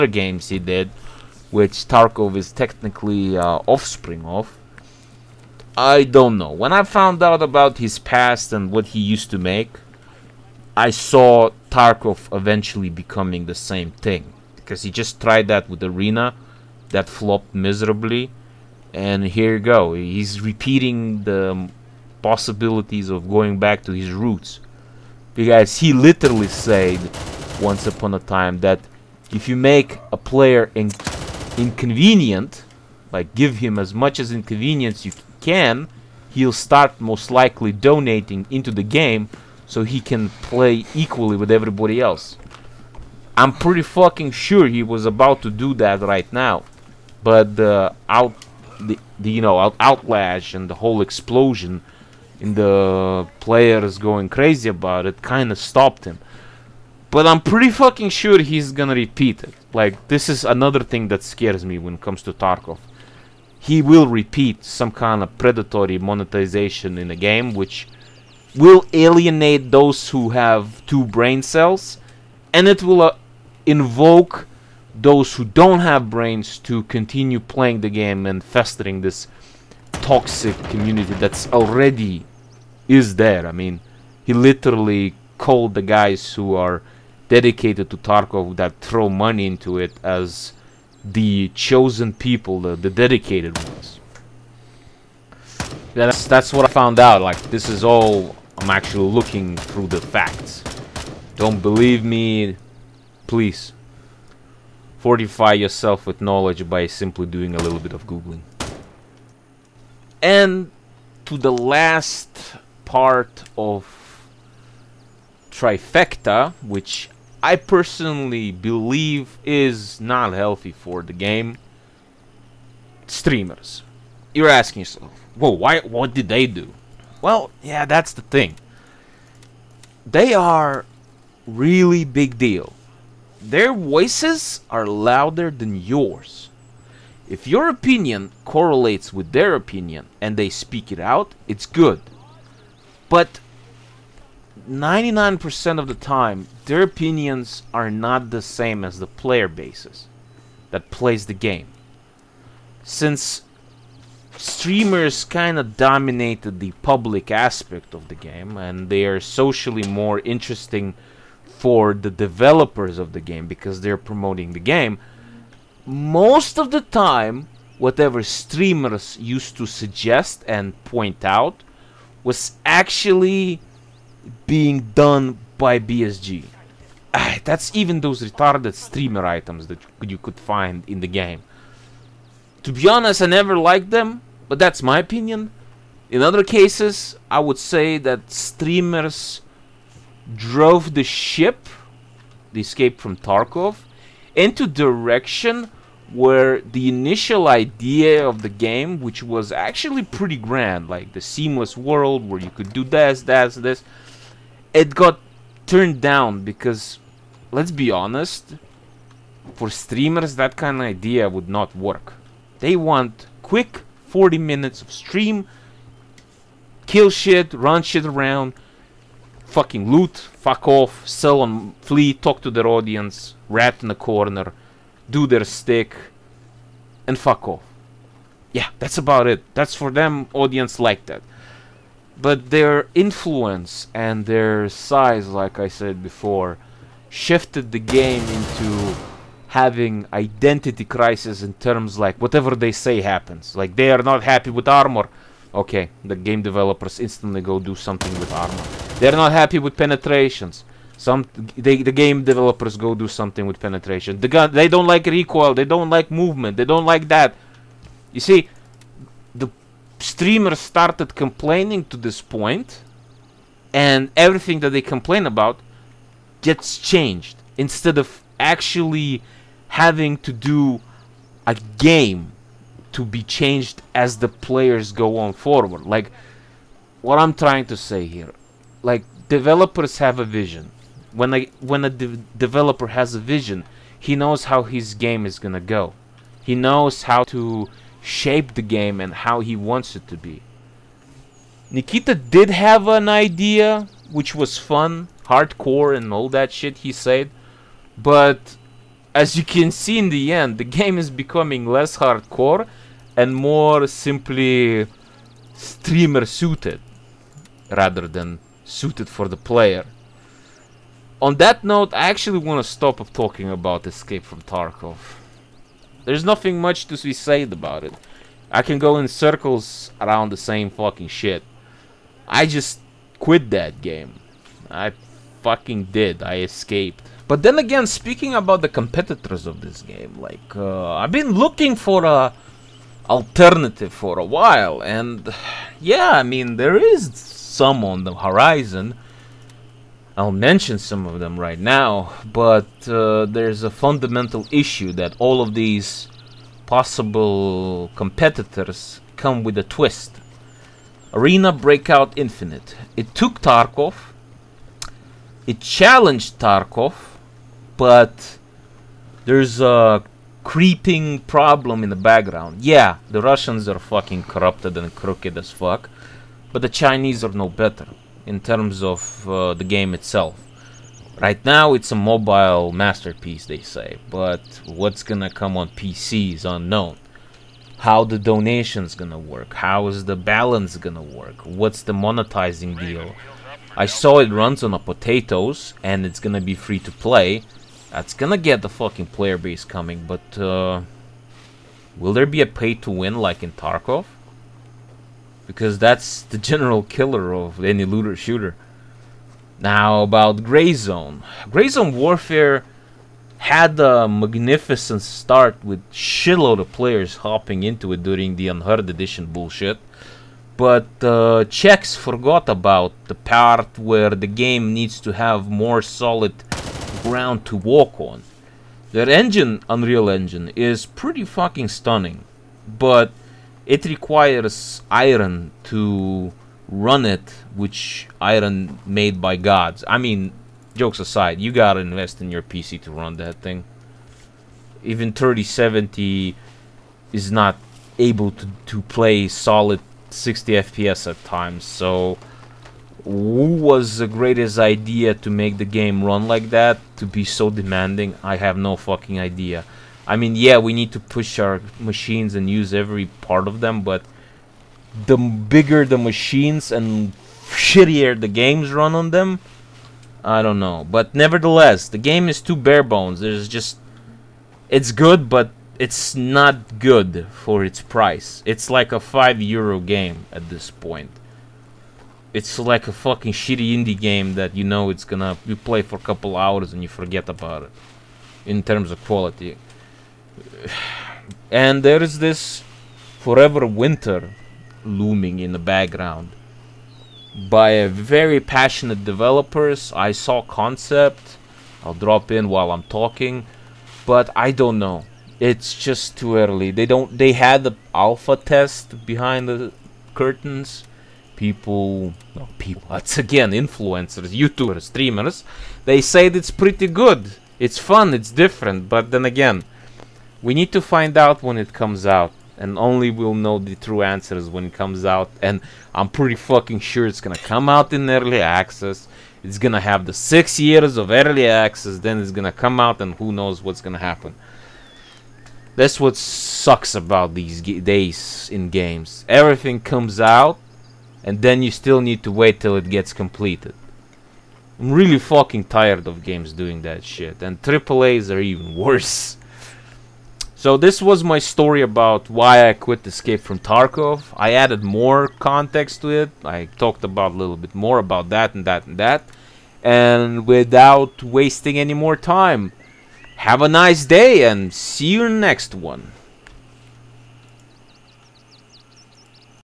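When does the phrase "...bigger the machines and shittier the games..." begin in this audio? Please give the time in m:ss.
7:35.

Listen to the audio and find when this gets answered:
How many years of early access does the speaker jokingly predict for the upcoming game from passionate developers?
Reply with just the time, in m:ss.
8:40.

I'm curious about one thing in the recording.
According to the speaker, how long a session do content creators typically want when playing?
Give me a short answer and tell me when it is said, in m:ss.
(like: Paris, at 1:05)
40 minutes, at 3:34.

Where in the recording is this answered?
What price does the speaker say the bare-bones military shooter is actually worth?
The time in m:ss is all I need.
7:48.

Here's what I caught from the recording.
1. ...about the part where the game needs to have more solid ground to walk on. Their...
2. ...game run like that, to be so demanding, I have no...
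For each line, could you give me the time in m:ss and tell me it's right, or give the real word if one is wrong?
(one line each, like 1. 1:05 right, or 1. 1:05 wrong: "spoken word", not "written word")
1. 6:52 right
2. 7:25 right.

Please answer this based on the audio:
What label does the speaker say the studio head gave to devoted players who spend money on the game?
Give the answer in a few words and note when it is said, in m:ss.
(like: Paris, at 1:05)
the chosen people, at 1:31.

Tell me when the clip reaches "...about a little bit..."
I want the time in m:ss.
9:07.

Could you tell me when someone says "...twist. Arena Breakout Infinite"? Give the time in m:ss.
5:49.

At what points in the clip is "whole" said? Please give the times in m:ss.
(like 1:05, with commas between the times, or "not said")
0:50.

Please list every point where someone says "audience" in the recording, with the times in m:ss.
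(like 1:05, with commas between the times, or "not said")
3:42, 3:50.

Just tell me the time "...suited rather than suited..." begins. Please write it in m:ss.
5:06.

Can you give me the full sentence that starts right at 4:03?
Like they are not happy with armor.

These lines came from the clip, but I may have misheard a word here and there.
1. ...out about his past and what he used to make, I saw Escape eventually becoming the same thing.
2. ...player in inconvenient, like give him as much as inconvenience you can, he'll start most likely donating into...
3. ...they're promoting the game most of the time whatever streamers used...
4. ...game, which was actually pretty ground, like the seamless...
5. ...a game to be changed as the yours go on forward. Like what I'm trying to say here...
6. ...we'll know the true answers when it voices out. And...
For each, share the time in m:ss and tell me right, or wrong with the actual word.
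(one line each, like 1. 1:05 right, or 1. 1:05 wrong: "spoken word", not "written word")
1. 0:07 wrong: "Tarkov", not "Escape"
2. 0:30 right
3. 2:43 right
4. 3:18 wrong: "grand", not "ground"
5. 4:31 wrong: "players", not "yours"
6. 8:33 wrong: "comes", not "voices".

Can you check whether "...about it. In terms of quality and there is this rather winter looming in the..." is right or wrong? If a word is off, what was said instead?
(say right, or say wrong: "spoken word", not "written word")
wrong: "forever", not "rather".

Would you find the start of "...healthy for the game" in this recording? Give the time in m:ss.
2:00.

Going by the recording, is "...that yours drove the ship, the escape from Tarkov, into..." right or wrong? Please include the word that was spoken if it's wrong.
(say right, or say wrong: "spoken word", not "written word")
wrong: "streamers", not "yours".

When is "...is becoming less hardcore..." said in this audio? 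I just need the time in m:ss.
5:00.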